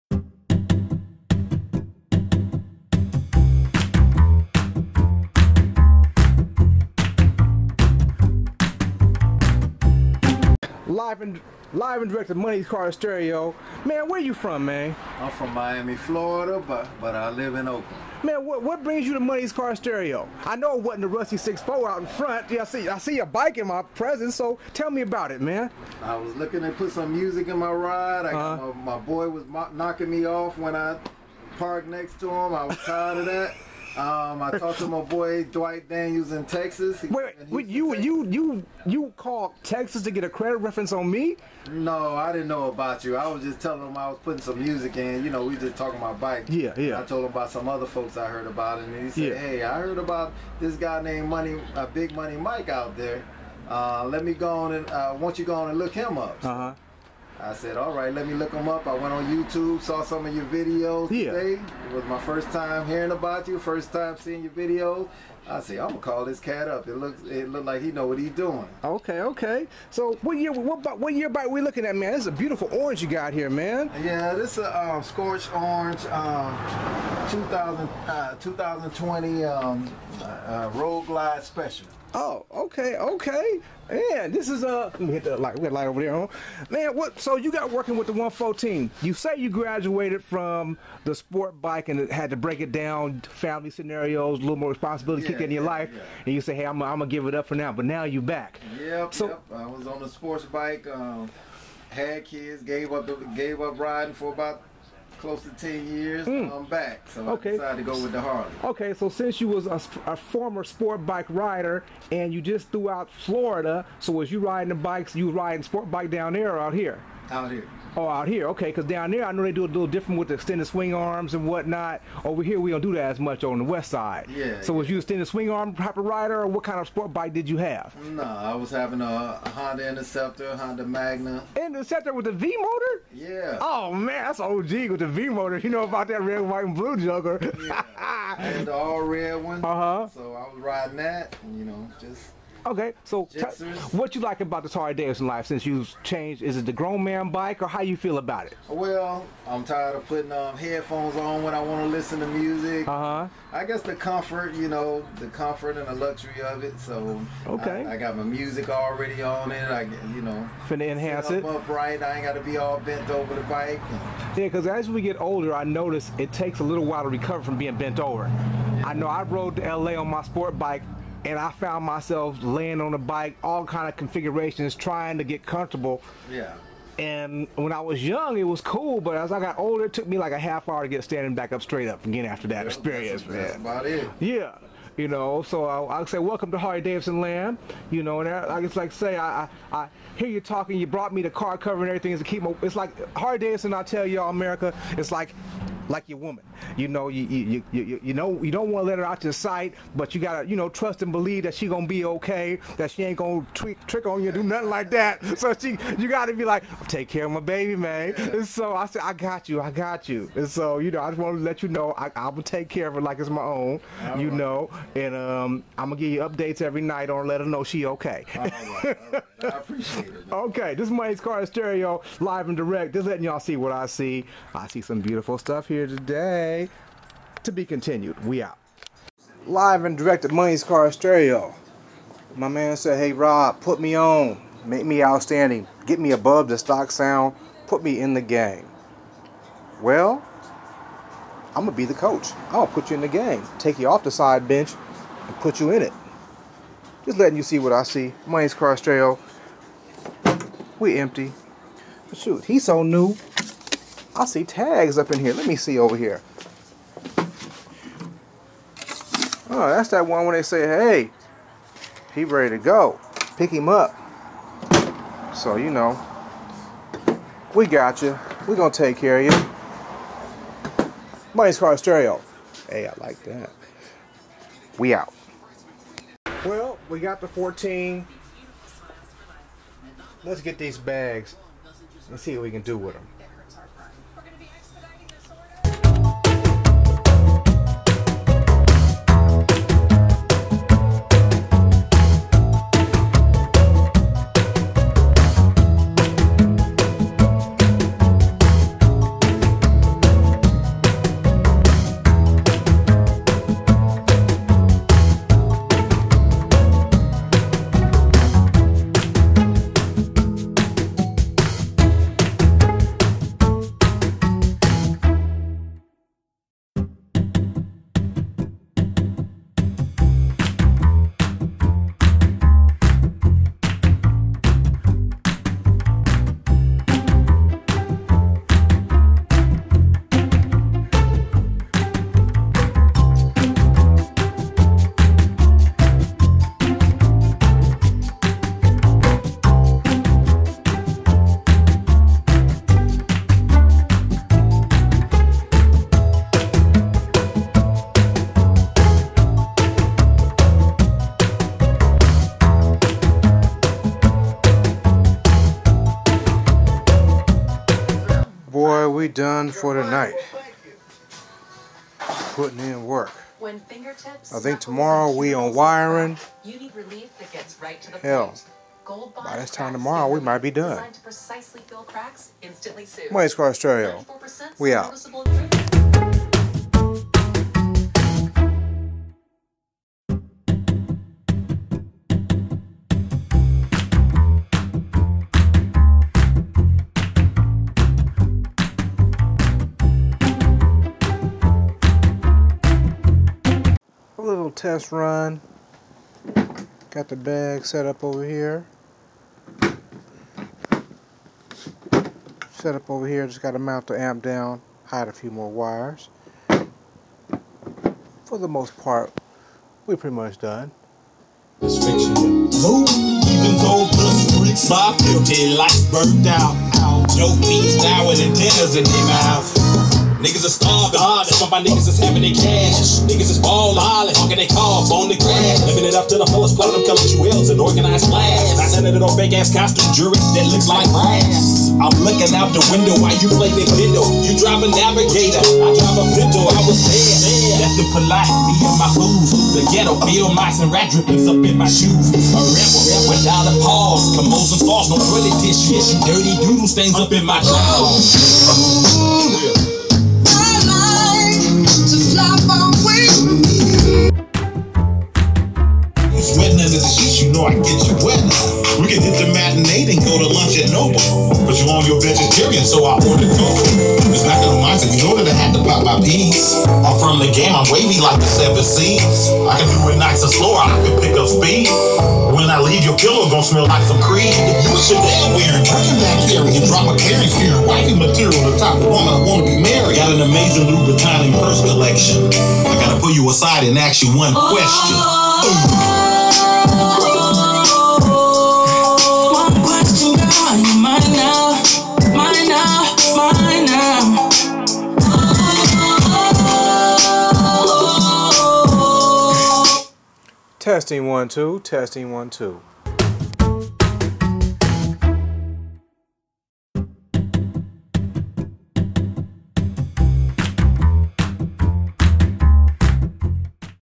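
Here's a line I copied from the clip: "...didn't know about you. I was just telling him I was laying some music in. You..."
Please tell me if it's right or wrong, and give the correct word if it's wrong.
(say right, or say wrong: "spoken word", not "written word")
wrong: "putting", not "laying".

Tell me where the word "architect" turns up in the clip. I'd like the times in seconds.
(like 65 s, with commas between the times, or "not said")
not said.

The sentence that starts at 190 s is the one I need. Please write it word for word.
You brought me the car cover and everything.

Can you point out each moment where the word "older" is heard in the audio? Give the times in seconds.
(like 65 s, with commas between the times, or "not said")
165 s, 179 s.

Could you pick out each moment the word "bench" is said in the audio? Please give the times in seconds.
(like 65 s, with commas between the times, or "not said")
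244 s.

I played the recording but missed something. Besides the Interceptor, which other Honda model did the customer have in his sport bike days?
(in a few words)
Honda Magna.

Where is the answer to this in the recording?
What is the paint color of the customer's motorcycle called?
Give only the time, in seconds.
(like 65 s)
75 s.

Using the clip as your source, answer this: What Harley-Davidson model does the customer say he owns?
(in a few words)
Road Glide Special.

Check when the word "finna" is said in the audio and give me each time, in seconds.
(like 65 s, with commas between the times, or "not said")
160 s.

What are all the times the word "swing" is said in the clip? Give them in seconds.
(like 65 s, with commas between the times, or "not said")
120 s, 125 s.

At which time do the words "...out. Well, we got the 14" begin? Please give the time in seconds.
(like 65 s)
274 s.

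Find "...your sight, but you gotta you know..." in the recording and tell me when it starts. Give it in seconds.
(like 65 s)
199 s.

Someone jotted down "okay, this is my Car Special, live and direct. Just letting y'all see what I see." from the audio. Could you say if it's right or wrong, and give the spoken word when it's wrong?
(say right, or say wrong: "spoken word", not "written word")
wrong: "Stereo", not "Special".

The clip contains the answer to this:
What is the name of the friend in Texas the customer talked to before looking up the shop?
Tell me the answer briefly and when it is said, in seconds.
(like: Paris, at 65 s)
Dwight Daniels, at 35 s.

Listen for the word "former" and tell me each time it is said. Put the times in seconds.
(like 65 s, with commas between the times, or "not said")
110 s.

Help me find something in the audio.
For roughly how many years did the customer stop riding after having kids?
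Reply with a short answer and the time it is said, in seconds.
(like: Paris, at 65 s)
10, at 105 s.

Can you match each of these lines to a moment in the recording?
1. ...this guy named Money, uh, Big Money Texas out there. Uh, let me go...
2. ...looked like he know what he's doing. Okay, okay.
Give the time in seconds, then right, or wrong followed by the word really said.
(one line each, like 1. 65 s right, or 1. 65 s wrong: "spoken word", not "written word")
1. 50 s wrong: "Mike", not "Texas"
2. 67 s right.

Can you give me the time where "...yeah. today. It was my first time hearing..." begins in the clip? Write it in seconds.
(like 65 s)
61 s.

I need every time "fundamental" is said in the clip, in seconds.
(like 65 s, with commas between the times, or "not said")
not said.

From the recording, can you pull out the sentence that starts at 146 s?
Is it the grown man bike or how you feel about it?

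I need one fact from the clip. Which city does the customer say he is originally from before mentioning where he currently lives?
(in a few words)
Miami.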